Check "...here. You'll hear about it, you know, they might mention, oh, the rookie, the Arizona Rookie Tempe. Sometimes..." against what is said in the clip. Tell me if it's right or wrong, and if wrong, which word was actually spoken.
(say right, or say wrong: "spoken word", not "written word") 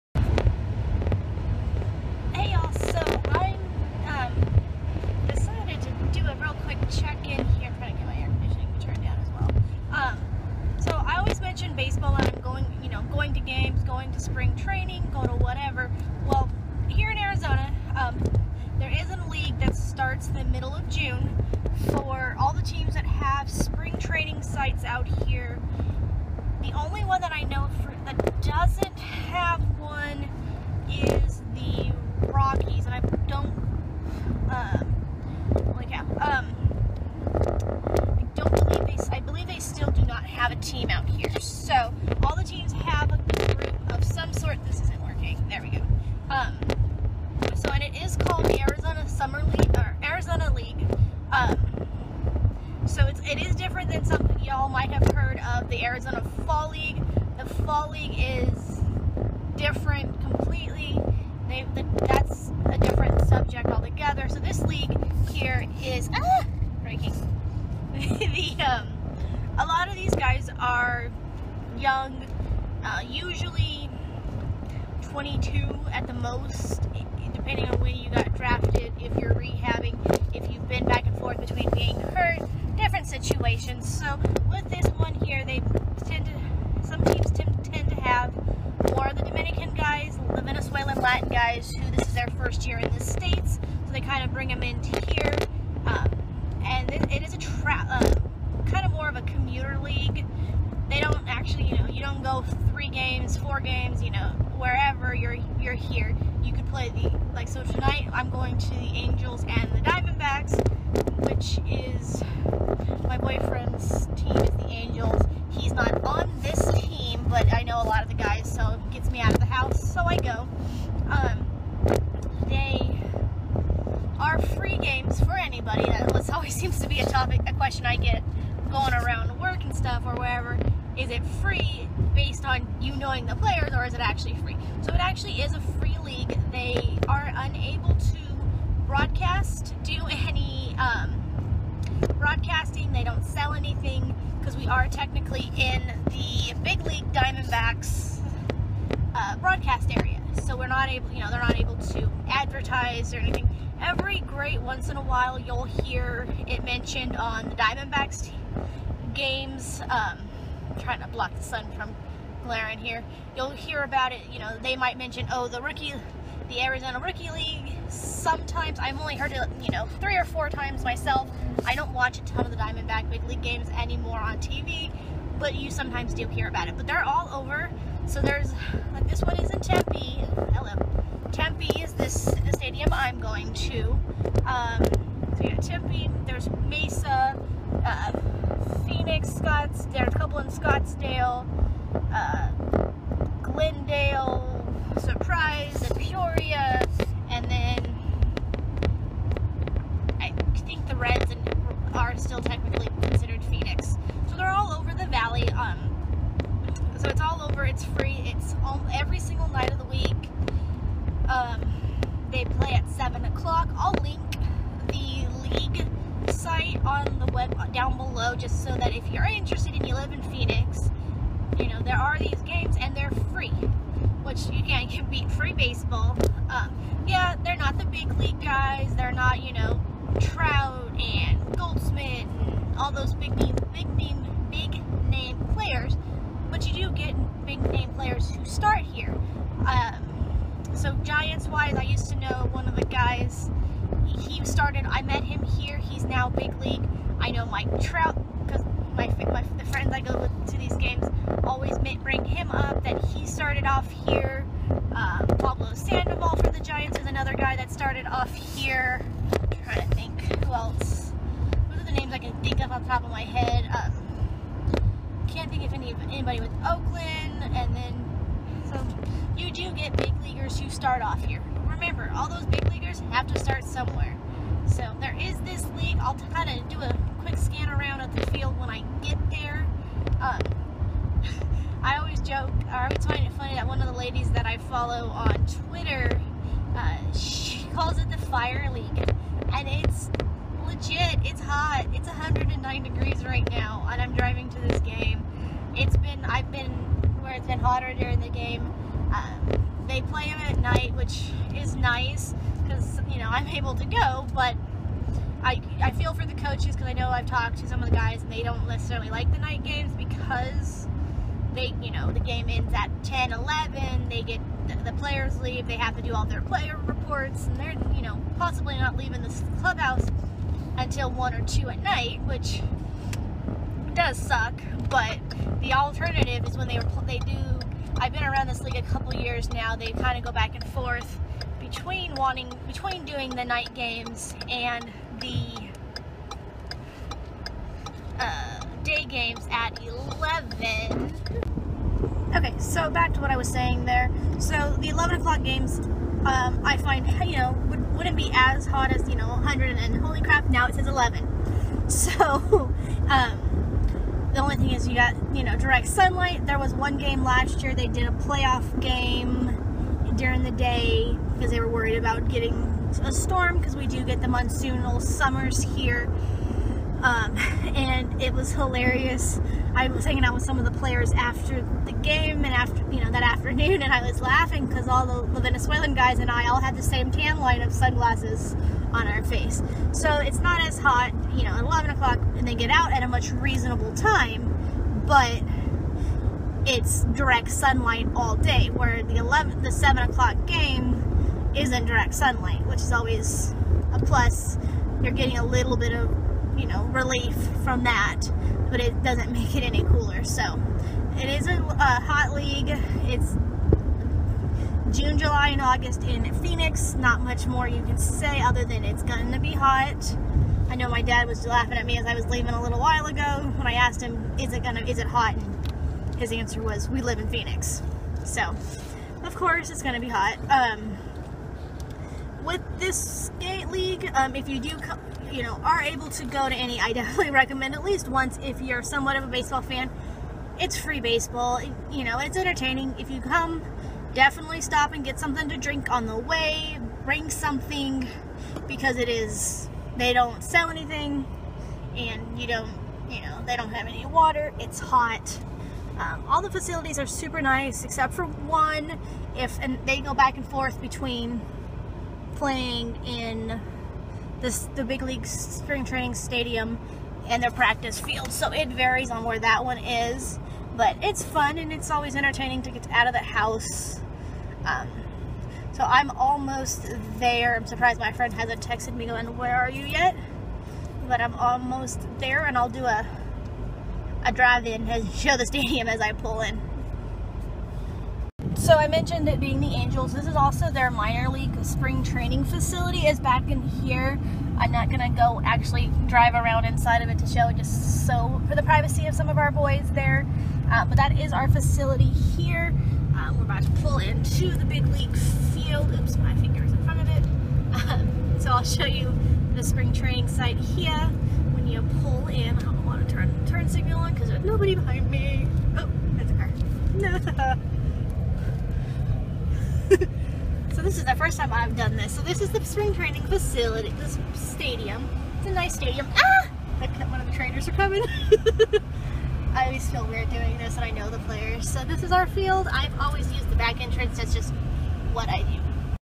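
wrong: "League", not "Tempe".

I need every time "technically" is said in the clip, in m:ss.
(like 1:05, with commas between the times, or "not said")
2:24.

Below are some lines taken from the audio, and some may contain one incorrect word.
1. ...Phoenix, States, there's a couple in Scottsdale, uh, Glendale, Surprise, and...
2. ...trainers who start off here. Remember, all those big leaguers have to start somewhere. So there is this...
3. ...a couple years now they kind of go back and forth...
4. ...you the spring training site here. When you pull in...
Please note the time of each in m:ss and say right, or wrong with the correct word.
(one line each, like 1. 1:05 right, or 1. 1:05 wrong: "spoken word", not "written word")
1. 3:08 wrong: "Scotts", not "States"
2. 4:30 wrong: "leaguers", not "trainers"
3. 5:28 right
4. 8:18 right.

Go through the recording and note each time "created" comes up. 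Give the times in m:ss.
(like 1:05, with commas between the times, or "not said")
not said.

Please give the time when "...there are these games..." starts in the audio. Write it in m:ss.
3:41.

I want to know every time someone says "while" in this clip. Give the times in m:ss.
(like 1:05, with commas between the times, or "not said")
2:35, 6:52.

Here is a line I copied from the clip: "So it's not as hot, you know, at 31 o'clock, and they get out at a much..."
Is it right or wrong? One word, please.
wrong.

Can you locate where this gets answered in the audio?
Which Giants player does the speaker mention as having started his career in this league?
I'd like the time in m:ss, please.
4:15.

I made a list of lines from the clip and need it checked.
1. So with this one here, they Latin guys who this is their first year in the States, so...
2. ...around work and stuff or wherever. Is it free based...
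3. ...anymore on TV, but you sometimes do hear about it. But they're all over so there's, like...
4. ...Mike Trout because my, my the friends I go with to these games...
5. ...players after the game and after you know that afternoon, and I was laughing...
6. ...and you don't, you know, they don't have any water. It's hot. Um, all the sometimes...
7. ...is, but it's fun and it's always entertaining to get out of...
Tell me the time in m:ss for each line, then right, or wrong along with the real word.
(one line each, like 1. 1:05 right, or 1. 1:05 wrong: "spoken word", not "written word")
1. 1:23 right
2. 2:08 right
3. 2:53 right
4. 4:07 right
5. 6:10 right
6. 7:21 wrong: "facilities", not "sometimes"
7. 7:39 right.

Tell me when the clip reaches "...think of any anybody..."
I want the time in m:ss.
4:25.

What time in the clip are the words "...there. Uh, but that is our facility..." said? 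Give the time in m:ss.
8:09.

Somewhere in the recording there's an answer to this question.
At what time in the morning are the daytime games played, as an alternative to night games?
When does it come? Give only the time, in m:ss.
5:38.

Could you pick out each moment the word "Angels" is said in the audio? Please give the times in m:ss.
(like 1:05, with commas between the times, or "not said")
1:48, 1:54, 7:59.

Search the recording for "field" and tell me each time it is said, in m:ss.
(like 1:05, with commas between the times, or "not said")
4:38, 7:37, 8:15, 8:42.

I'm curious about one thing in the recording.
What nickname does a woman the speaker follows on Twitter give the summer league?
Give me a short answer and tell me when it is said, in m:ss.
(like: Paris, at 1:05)
the fire league, at 4:48.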